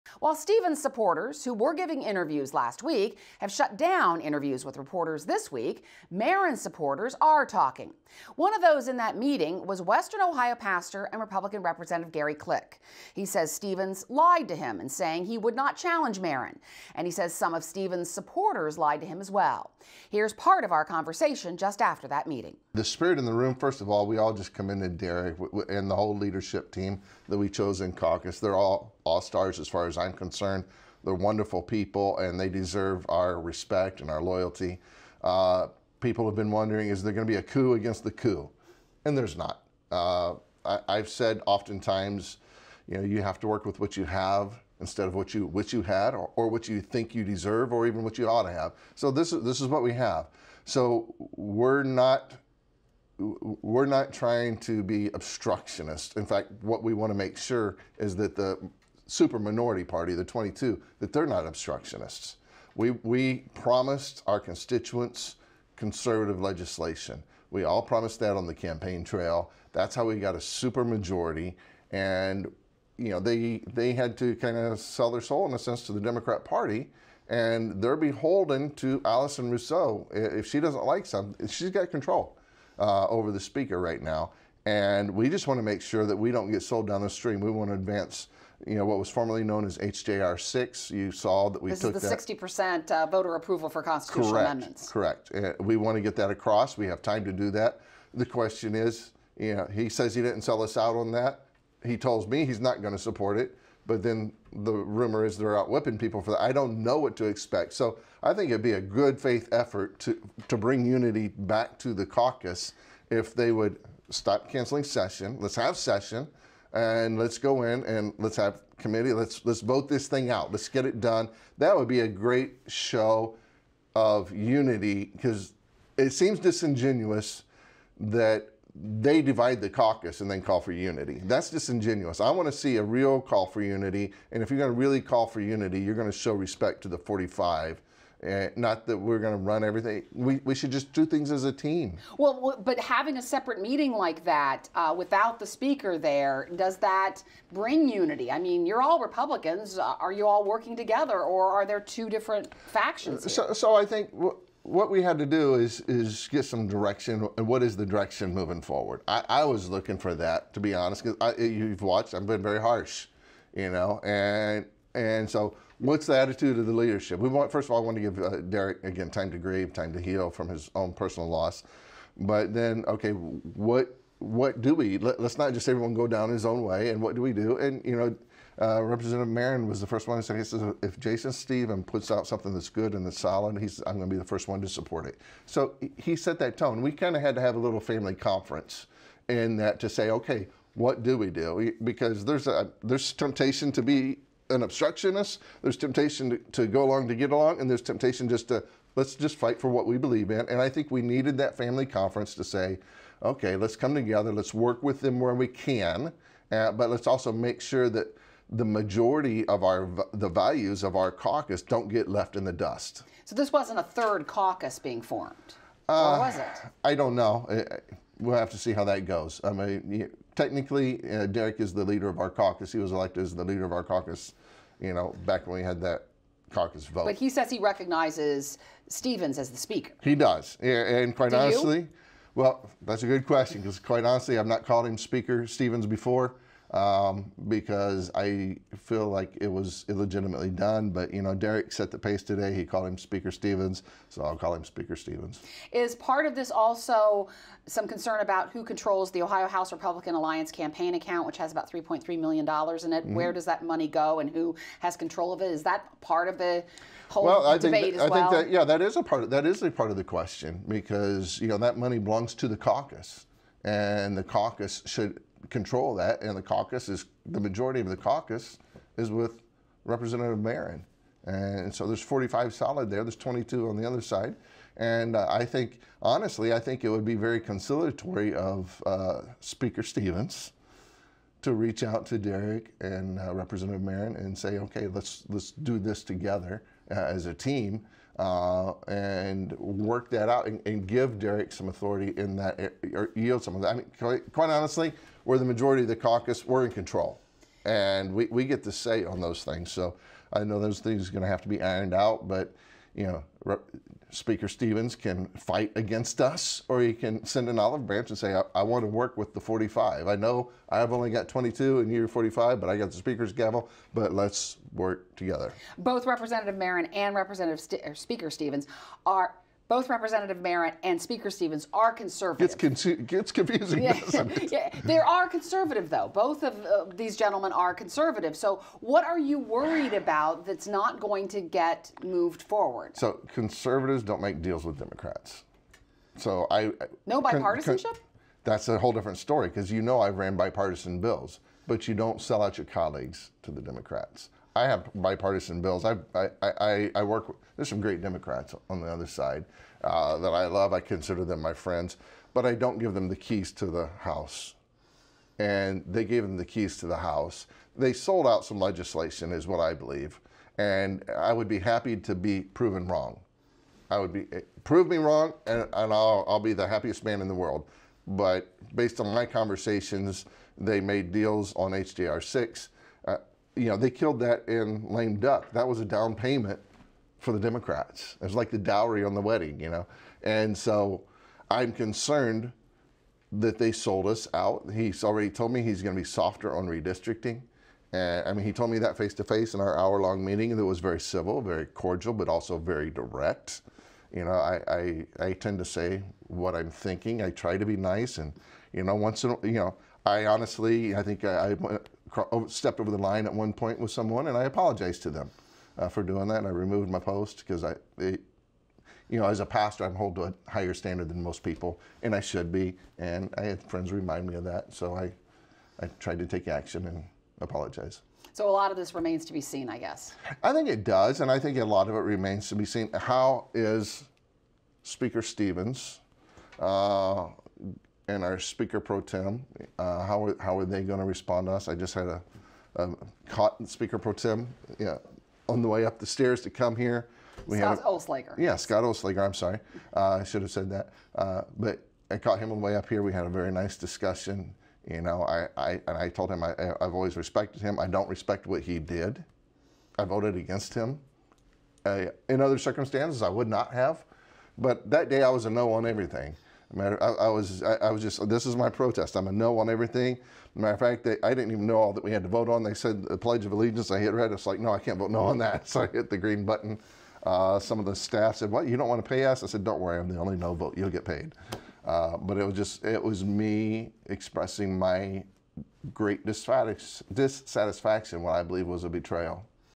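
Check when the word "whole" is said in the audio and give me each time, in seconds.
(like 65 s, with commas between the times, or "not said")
25 s, 257 s, 338 s.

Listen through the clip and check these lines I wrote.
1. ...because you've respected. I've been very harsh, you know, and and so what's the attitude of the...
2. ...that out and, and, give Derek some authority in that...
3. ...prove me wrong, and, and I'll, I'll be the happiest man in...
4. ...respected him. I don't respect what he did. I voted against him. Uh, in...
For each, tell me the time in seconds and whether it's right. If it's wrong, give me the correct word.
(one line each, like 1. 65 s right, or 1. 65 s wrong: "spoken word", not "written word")
1. 161 s wrong: "watched", not "respected"
2. 290 s right
3. 364 s right
4. 447 s right.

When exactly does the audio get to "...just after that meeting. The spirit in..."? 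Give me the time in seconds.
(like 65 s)
21 s.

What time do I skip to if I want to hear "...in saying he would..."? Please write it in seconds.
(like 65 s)
14 s.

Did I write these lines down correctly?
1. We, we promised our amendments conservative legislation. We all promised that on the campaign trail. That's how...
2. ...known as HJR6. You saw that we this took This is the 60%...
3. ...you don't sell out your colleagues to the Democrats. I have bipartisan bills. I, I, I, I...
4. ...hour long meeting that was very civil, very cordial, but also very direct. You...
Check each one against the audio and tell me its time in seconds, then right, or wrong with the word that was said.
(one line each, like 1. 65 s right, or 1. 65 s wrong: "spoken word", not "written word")
1. 62 s wrong: "constituents", not "amendments"
2. 89 s right
3. 341 s right
4. 389 s right.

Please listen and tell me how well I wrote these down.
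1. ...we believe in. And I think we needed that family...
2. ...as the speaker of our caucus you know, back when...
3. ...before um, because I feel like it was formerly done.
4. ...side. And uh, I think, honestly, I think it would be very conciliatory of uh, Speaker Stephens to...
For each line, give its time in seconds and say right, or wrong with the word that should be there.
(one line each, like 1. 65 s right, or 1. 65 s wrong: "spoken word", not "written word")
1. 199 s right
2. 223 s wrong: "leader", not "speaker"
3. 235 s wrong: "illegitimately", not "formerly"
4. 274 s right.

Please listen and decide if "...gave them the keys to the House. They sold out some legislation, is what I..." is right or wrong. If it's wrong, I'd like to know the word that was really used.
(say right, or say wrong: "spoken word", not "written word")
right.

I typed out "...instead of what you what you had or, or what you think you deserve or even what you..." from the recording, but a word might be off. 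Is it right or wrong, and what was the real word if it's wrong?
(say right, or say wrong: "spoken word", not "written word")
right.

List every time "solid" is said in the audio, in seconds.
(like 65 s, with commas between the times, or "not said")
183 s, 272 s.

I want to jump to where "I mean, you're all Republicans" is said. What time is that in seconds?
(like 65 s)
148 s.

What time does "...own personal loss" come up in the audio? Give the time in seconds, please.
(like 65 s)
170 s.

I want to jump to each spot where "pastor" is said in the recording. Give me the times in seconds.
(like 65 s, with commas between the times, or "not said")
10 s, 409 s.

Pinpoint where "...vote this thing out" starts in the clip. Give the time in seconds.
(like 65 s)
119 s.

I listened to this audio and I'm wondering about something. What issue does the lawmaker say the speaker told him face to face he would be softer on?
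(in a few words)
Redistricting.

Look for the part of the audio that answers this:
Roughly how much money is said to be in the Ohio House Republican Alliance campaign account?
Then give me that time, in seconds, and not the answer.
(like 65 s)
251 s.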